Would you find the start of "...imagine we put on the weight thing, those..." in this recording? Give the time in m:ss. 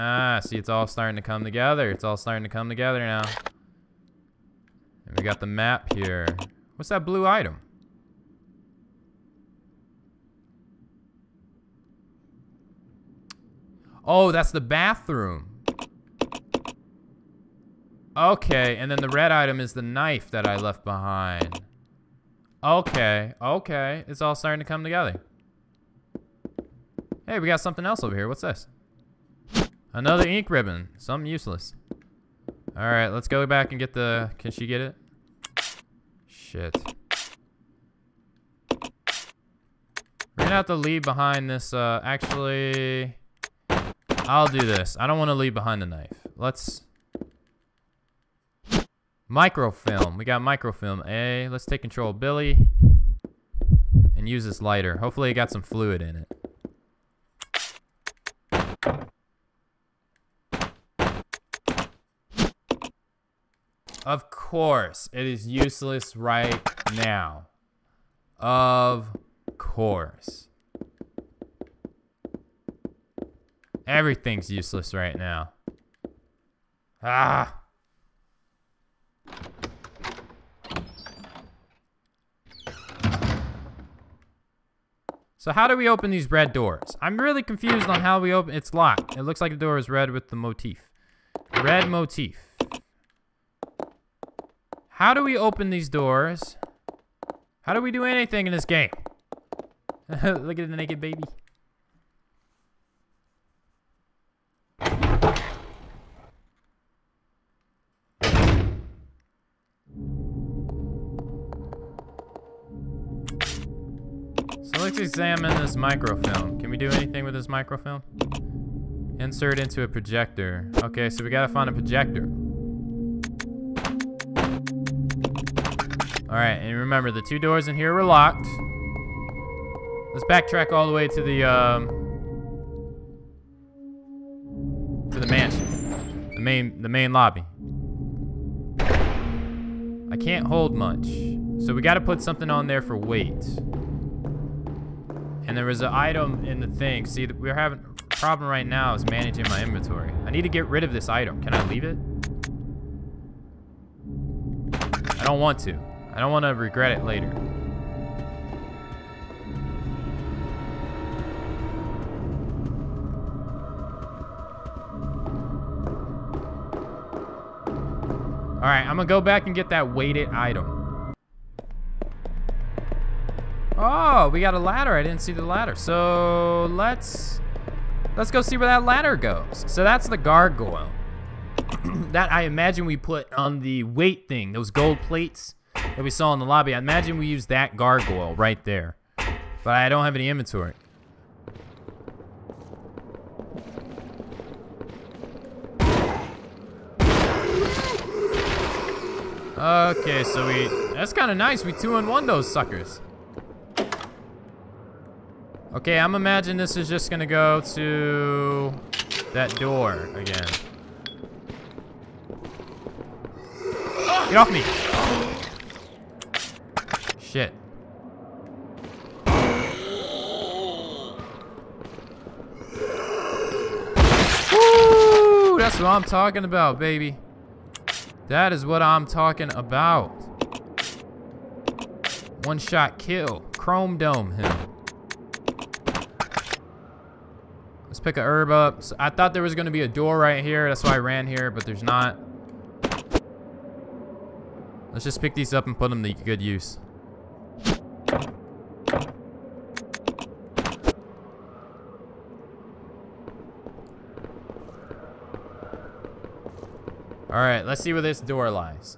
3:02.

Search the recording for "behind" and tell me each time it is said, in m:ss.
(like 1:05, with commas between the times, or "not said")
0:20, 0:41, 0:45.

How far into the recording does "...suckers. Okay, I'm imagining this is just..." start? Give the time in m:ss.
3:22.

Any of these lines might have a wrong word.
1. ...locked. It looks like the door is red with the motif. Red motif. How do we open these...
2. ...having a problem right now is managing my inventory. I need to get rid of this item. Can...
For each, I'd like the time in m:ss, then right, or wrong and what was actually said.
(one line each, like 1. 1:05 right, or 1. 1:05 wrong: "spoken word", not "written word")
1. 1:28 right
2. 2:27 right.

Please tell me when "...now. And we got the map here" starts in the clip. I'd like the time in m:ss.
0:03.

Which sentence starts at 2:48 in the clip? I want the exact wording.
All right, I'm gonna go back and get that weighted item.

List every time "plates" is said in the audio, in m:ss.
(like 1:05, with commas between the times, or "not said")
3:05.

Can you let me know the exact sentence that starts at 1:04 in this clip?
Of course, it is useless right now.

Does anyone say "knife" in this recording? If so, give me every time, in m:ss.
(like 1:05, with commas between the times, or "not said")
0:19, 0:45.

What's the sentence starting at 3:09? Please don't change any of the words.
But I don't have any inventory.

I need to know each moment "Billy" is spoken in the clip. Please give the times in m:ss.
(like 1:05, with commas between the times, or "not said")
0:52.